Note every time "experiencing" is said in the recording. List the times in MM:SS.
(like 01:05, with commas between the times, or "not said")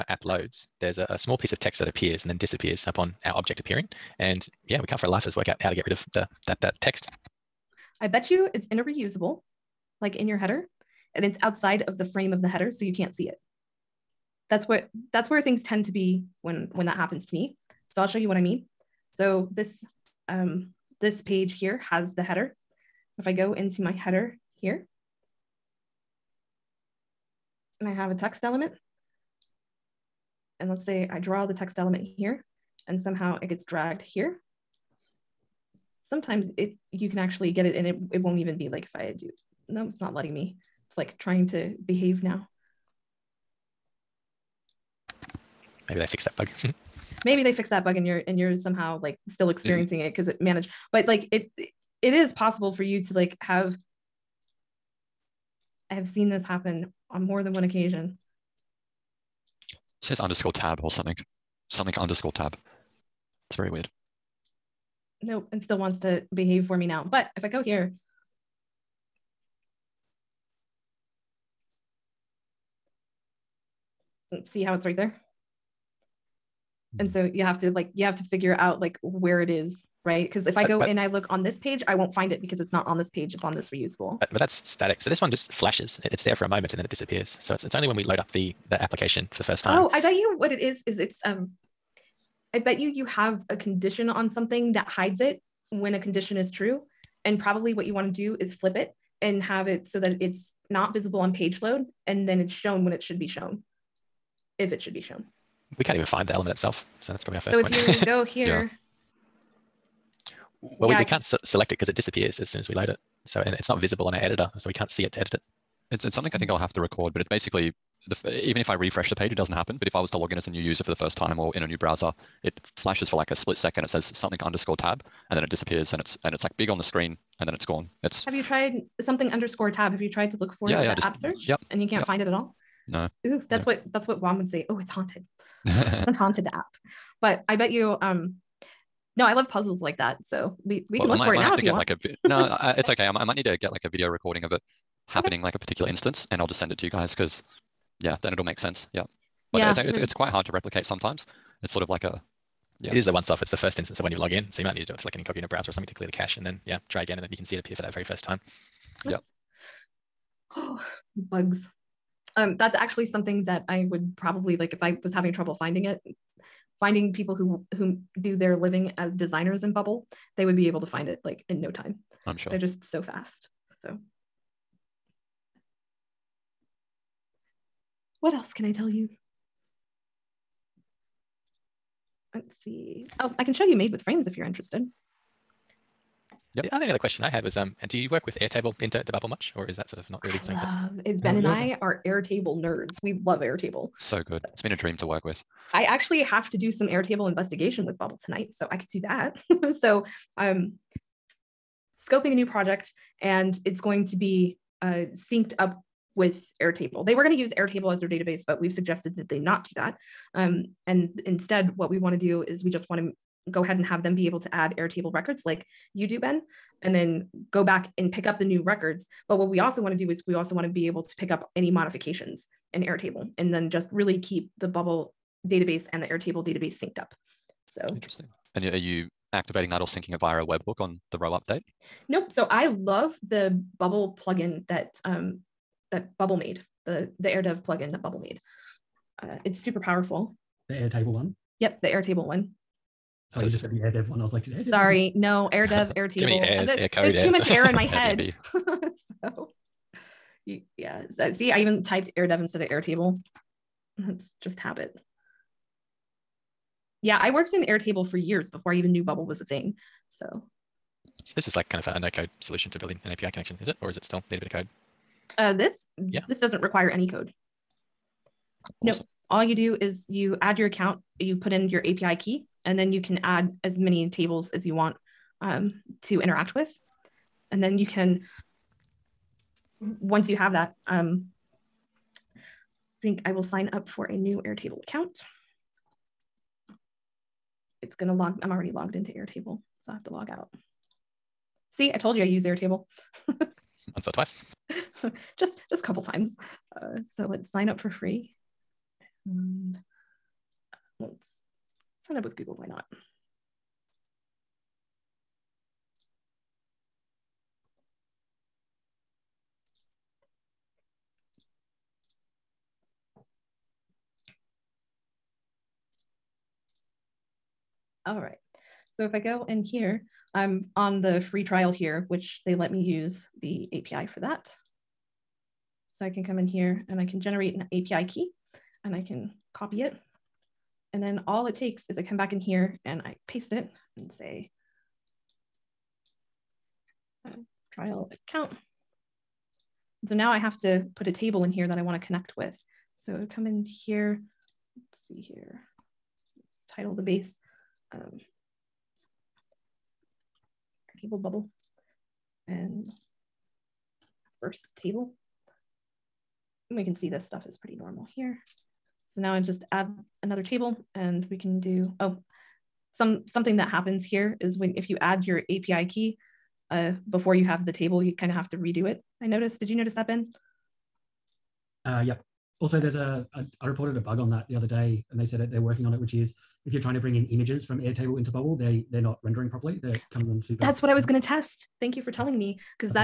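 00:49.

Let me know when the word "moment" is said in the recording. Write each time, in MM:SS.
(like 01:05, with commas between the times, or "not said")
01:26.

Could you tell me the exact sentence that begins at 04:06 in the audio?
too many airs, it, air code.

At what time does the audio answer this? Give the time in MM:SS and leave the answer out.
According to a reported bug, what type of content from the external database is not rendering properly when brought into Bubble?
06:17.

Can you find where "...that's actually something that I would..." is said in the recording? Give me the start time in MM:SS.
02:42.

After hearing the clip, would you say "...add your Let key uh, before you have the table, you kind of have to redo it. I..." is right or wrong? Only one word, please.
wrong.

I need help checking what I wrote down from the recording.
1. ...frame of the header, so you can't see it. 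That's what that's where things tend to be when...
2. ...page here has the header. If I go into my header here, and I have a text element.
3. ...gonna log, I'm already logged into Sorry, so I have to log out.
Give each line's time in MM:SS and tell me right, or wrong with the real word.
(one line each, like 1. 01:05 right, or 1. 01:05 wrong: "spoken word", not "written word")
1. 00:12 right
2. 00:21 right
3. 04:47 wrong: "Airtable", not "Sorry".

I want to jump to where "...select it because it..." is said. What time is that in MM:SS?
01:51.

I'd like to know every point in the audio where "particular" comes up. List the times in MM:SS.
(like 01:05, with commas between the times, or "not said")
02:25.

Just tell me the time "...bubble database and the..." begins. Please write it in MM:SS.
03:44.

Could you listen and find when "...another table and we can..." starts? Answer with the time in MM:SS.
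06:00.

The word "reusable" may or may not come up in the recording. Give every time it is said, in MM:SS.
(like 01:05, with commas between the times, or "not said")
00:08, 01:23.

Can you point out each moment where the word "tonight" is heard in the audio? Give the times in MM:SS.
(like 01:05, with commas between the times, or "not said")
03:18.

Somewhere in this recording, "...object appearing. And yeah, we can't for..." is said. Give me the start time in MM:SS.
00:03.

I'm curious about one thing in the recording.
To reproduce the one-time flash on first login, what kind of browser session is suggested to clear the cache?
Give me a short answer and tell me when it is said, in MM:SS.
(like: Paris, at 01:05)
incognito browser, at 02:35.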